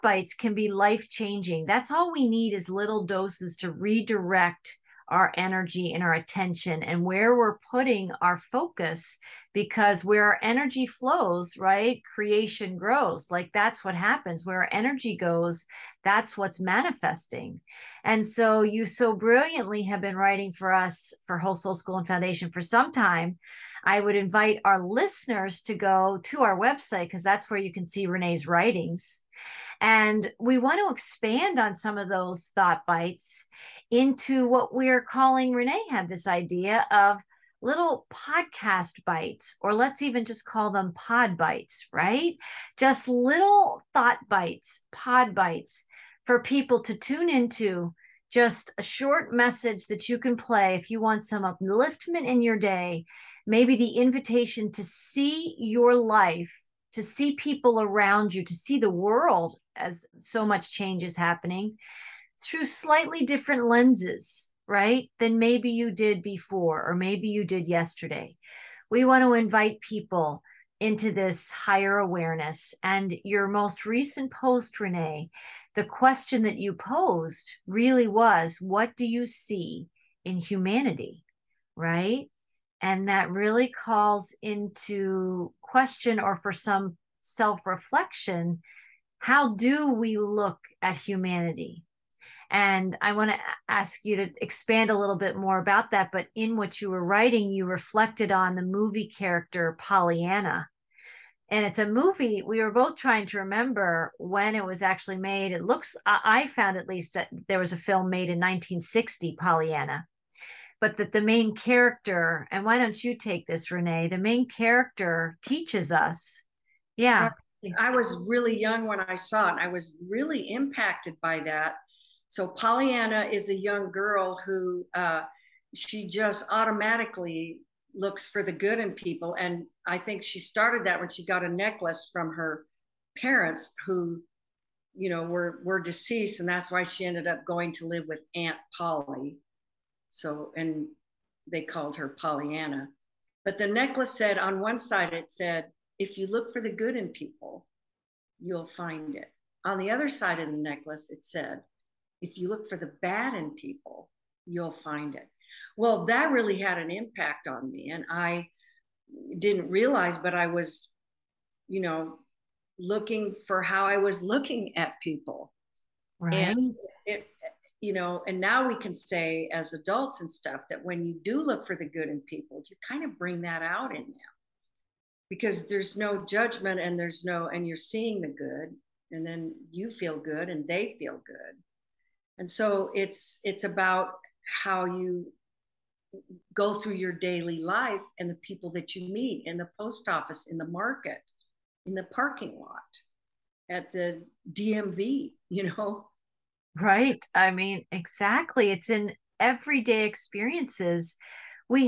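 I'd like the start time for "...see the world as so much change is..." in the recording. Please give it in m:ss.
0:58.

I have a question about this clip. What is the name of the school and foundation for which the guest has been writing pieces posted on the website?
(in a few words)
Whole Soul School.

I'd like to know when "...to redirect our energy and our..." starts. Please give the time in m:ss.
0:03.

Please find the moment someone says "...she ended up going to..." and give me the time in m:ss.
2:16.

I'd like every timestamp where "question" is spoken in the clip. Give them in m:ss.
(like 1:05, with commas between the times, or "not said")
1:15, 1:25.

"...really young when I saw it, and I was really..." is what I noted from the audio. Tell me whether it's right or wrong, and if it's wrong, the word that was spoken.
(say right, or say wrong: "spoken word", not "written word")
right.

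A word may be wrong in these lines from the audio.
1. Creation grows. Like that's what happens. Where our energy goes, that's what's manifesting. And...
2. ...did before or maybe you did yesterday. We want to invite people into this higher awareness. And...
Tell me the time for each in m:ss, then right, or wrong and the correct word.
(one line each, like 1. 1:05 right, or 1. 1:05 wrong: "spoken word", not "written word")
1. 0:12 right
2. 1:05 right.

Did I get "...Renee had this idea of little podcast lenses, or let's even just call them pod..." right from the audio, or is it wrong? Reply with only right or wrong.
wrong.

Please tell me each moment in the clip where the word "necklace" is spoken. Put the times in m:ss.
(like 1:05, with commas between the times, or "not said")
2:11, 2:23, 2:30.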